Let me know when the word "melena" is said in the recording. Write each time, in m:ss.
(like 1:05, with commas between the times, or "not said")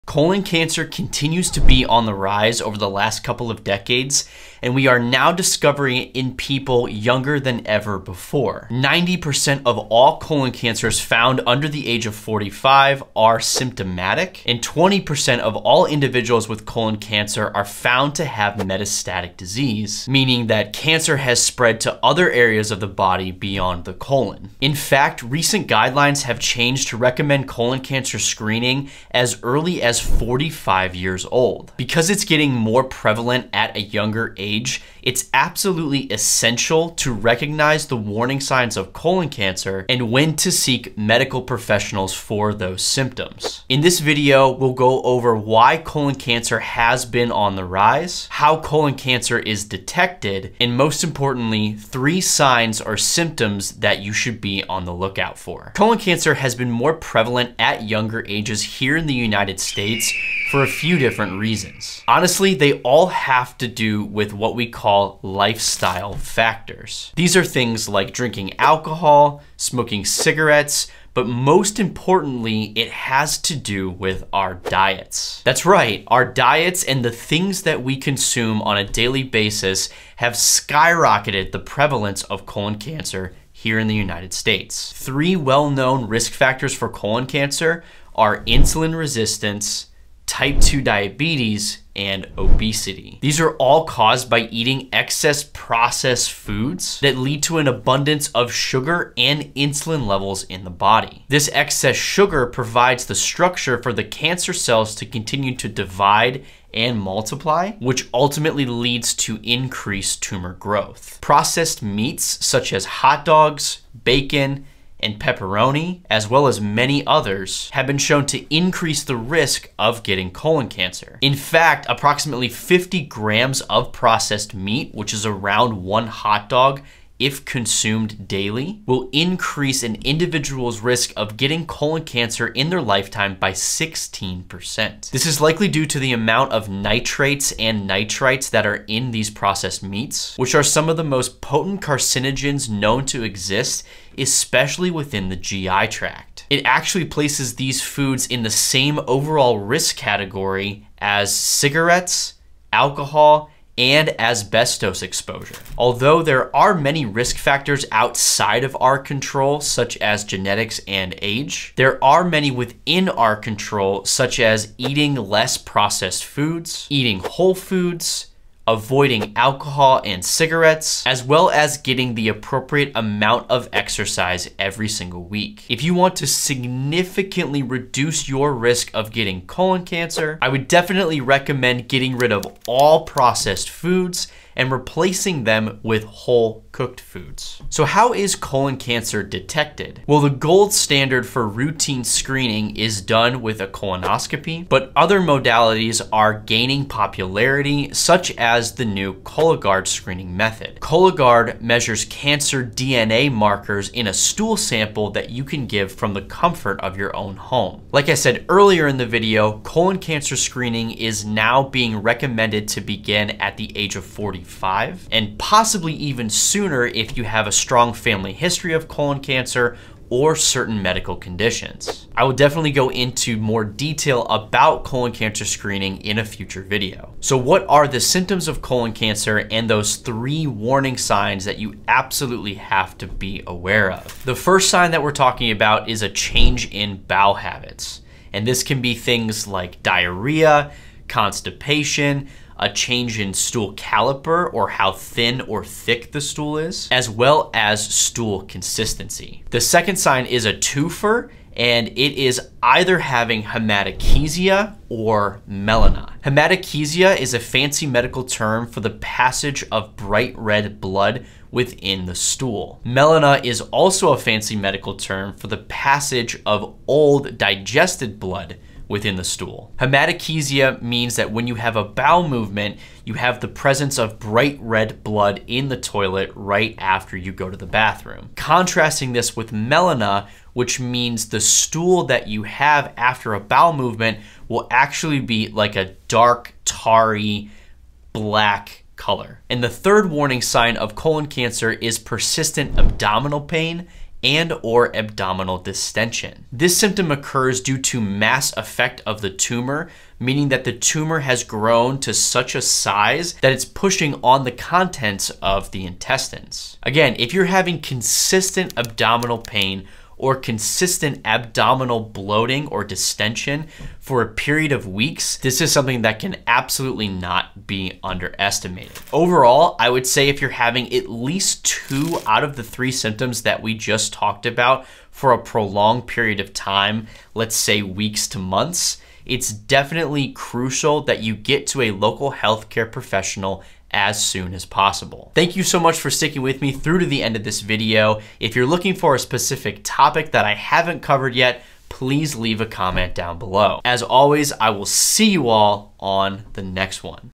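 4:15, 4:22, 4:39.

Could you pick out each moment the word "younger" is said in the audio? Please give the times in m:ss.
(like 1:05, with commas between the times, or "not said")
0:06, 0:33, 0:57.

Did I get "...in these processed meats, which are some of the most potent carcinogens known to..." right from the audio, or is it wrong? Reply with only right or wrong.
right.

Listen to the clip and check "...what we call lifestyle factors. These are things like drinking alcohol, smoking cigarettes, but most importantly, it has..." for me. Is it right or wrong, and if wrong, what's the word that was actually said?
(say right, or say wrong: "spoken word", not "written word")
right.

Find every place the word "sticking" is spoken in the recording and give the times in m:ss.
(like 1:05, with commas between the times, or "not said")
5:36.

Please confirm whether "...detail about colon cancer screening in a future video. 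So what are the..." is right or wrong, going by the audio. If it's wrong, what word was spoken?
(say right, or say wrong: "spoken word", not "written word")
right.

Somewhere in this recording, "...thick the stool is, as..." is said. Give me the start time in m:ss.
4:05.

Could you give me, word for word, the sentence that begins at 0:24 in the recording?
In fact, recent guidelines have changed to recommend colon cancer screening as early as 45 years old.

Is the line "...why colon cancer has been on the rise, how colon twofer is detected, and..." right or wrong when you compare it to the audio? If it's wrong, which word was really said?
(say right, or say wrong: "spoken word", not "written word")
wrong: "cancer", not "twofer".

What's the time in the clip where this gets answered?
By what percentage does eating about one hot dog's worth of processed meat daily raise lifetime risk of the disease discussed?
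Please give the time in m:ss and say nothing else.
2:13.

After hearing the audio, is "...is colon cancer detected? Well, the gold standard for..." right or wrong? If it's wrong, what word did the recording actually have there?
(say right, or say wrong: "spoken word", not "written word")
right.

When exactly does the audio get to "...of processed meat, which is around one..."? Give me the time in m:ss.
2:03.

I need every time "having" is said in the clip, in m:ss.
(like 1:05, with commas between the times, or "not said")
4:12, 5:07, 5:20.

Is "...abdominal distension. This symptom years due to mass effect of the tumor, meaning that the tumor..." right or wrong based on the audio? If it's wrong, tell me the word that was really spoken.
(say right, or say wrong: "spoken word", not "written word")
wrong: "occurs", not "years".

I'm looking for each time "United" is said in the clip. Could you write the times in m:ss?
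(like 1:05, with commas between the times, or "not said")
0:59, 1:23.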